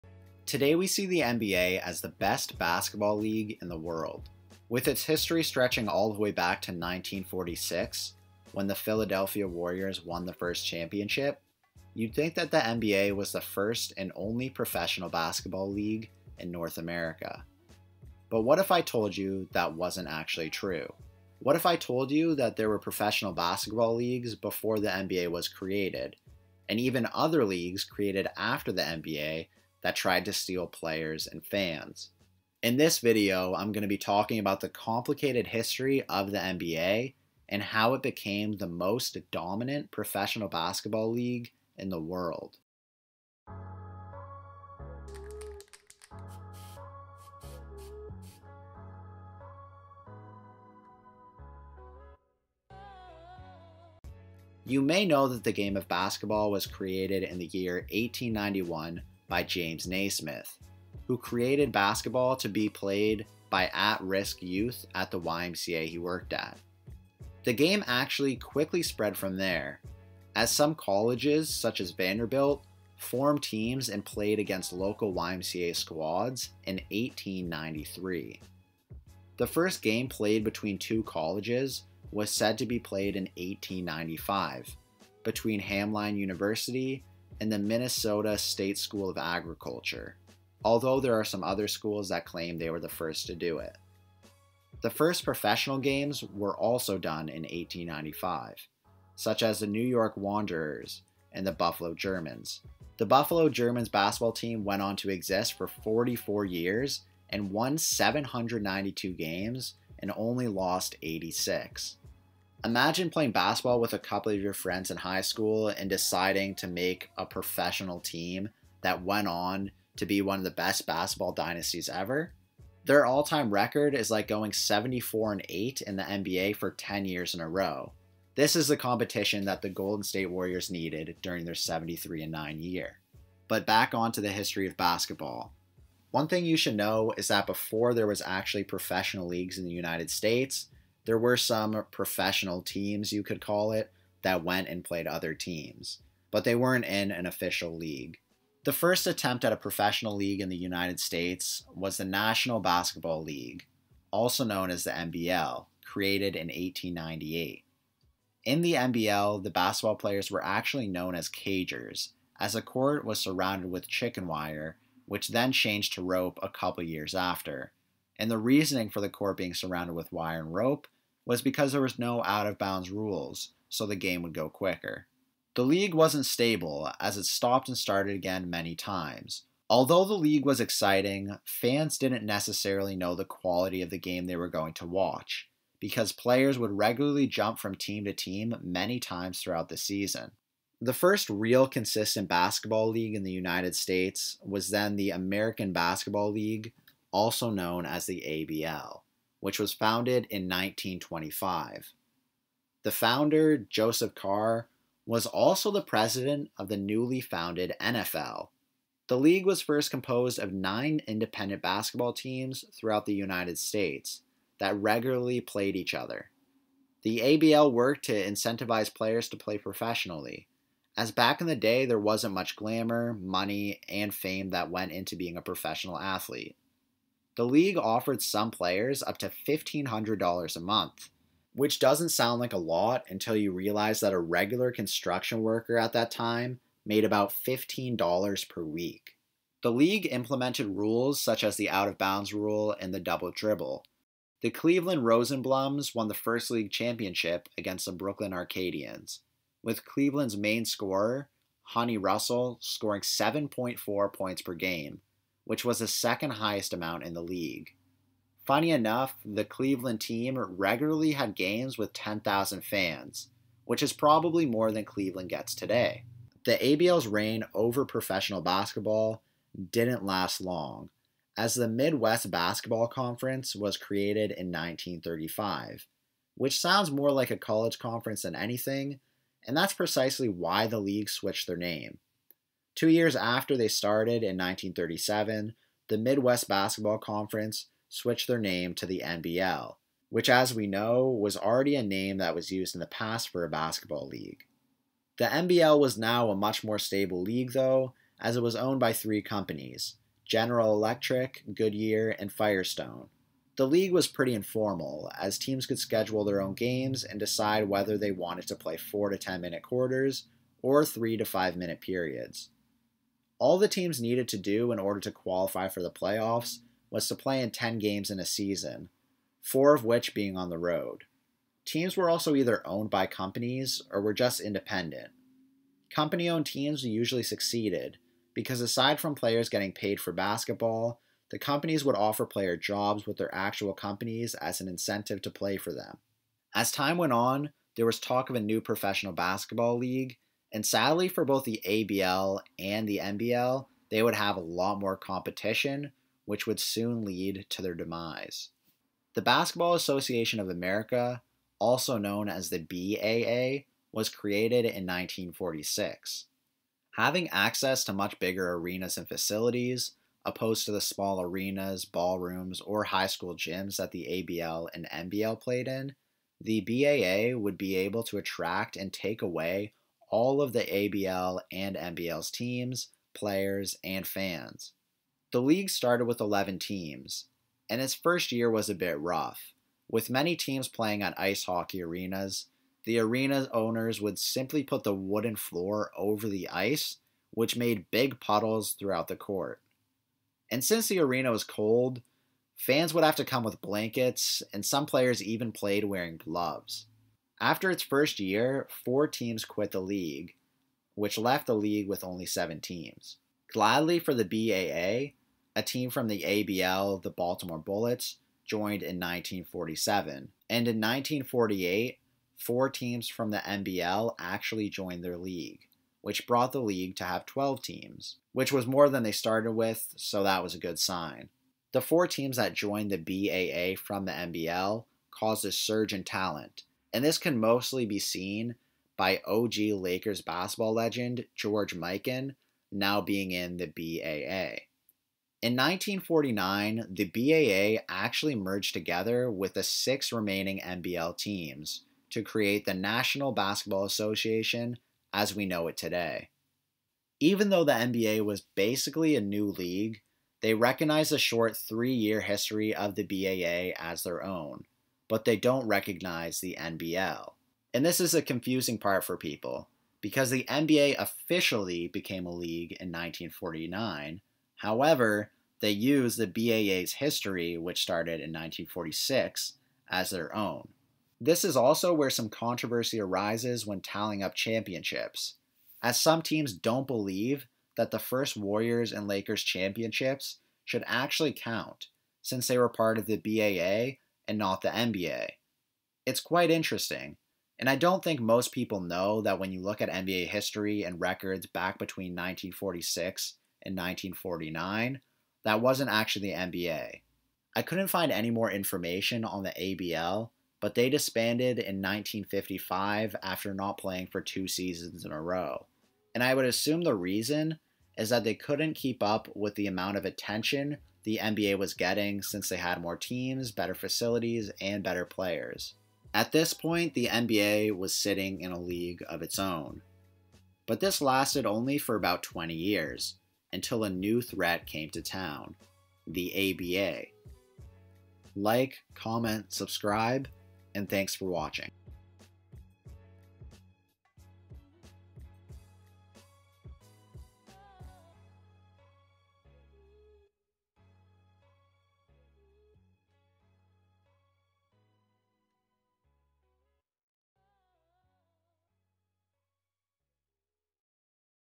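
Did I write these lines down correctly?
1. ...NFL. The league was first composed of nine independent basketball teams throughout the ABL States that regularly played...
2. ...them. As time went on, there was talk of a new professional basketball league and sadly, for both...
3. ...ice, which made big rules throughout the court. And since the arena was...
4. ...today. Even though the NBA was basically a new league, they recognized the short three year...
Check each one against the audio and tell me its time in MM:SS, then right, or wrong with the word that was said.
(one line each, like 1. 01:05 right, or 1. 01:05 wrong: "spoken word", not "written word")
1. 03:27 wrong: "United", not "ABL"
2. 05:35 right
3. 06:26 wrong: "puddles", not "rules"
4. 07:25 right.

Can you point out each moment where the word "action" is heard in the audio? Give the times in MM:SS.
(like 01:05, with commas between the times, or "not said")
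not said.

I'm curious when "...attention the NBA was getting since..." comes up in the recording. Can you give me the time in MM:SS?
08:30.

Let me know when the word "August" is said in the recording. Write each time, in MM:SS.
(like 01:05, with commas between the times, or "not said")
not said.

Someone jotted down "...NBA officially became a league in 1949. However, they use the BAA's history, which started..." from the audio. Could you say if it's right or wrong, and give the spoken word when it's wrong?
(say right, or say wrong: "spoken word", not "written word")
right.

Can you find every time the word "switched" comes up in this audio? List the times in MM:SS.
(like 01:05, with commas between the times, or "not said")
04:41, 04:47.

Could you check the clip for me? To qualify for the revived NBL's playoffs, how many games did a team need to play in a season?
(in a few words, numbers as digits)
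10.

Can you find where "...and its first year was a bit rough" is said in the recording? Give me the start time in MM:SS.
06:17.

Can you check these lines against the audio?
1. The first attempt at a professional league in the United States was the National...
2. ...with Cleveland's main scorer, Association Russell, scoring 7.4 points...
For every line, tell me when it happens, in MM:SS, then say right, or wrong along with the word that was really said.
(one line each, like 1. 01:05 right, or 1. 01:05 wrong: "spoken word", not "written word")
1. 02:28 right
2. 04:09 wrong: "Honey", not "Association".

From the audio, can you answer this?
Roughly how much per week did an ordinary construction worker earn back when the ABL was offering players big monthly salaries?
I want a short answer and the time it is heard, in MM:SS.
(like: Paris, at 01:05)
$15, at 03:57.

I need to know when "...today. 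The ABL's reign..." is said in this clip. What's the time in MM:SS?
04:25.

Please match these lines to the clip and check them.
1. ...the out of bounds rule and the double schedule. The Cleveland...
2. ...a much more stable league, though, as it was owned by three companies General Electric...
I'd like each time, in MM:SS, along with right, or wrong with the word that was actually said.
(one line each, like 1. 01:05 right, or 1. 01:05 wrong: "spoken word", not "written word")
1. 04:01 wrong: "dribble", not "schedule"
2. 04:56 right.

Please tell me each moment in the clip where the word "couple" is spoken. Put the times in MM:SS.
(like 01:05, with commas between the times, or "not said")
01:53, 02:46.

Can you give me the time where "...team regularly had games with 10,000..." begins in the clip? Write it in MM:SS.
04:19.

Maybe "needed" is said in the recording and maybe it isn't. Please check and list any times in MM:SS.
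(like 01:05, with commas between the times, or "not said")
02:10, 05:13.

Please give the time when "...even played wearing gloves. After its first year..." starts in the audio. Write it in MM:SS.
06:35.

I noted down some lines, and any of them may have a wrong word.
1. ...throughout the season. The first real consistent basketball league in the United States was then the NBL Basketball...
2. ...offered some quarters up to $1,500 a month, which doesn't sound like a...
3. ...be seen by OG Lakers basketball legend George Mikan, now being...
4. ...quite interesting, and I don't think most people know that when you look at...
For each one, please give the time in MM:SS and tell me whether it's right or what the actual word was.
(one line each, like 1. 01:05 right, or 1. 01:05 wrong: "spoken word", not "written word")
1. 03:09 wrong: "American", not "NBL"
2. 03:47 wrong: "players", not "quarters"
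3. 07:07 right
4. 08:06 right.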